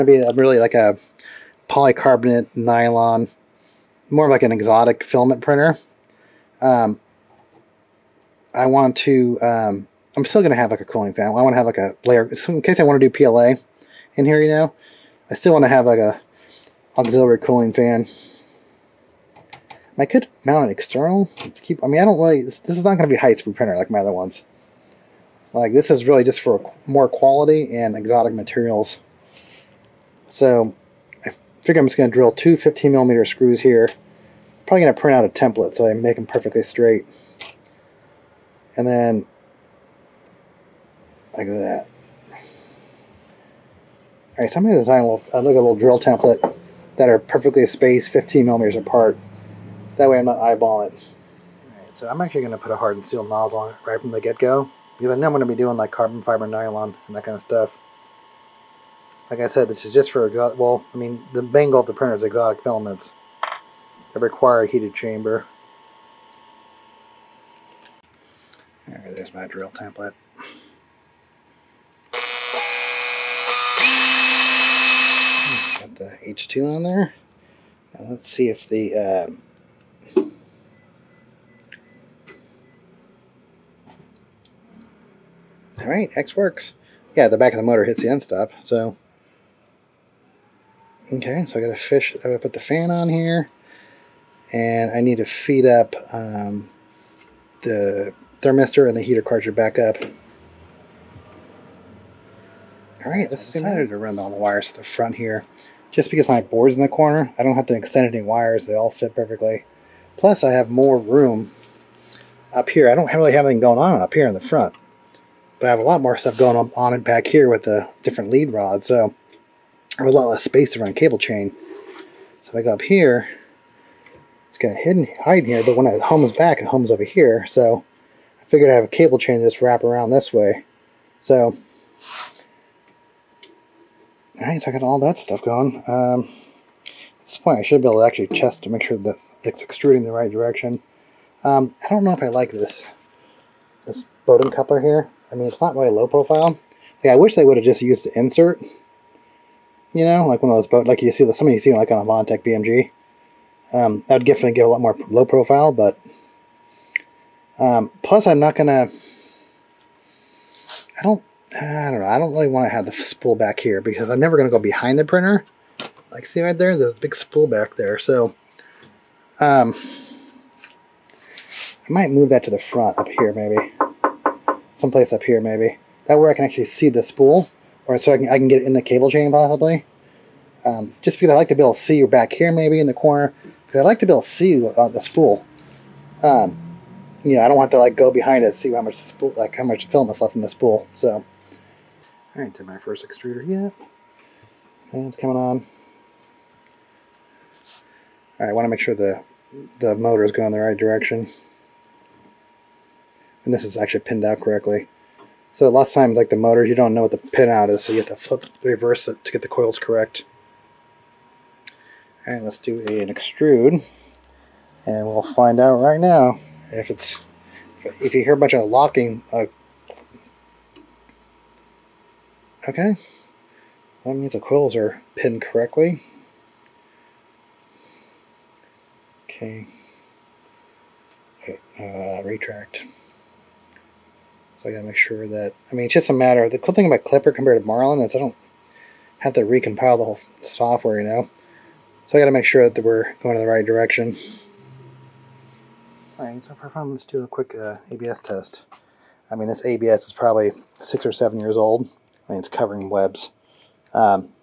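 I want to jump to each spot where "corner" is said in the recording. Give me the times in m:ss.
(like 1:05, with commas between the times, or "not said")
1:46, 3:02.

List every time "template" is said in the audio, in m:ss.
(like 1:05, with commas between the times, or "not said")
0:35, 0:45, 1:09.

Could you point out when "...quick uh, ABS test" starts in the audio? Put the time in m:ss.
4:07.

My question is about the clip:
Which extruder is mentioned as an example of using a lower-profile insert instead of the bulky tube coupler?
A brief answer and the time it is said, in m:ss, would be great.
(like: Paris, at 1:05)
Bondtech BMG, at 2:32.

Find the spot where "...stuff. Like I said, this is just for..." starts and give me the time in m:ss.
0:57.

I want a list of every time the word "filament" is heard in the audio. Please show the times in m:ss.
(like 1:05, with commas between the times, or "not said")
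0:05, 1:02.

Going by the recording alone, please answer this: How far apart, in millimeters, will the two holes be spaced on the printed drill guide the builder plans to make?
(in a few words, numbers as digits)
15 millimeters.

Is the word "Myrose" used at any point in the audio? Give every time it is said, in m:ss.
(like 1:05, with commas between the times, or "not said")
not said.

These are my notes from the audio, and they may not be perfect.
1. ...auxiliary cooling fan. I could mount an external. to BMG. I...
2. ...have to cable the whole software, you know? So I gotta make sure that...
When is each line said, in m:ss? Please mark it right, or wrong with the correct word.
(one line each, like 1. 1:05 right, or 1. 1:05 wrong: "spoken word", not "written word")
1. 0:16 wrong: "Keep", not "BMG"
2. 3:59 wrong: "recompile", not "cable".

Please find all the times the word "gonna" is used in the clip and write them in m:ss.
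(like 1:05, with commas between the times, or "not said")
2:38, 2:44.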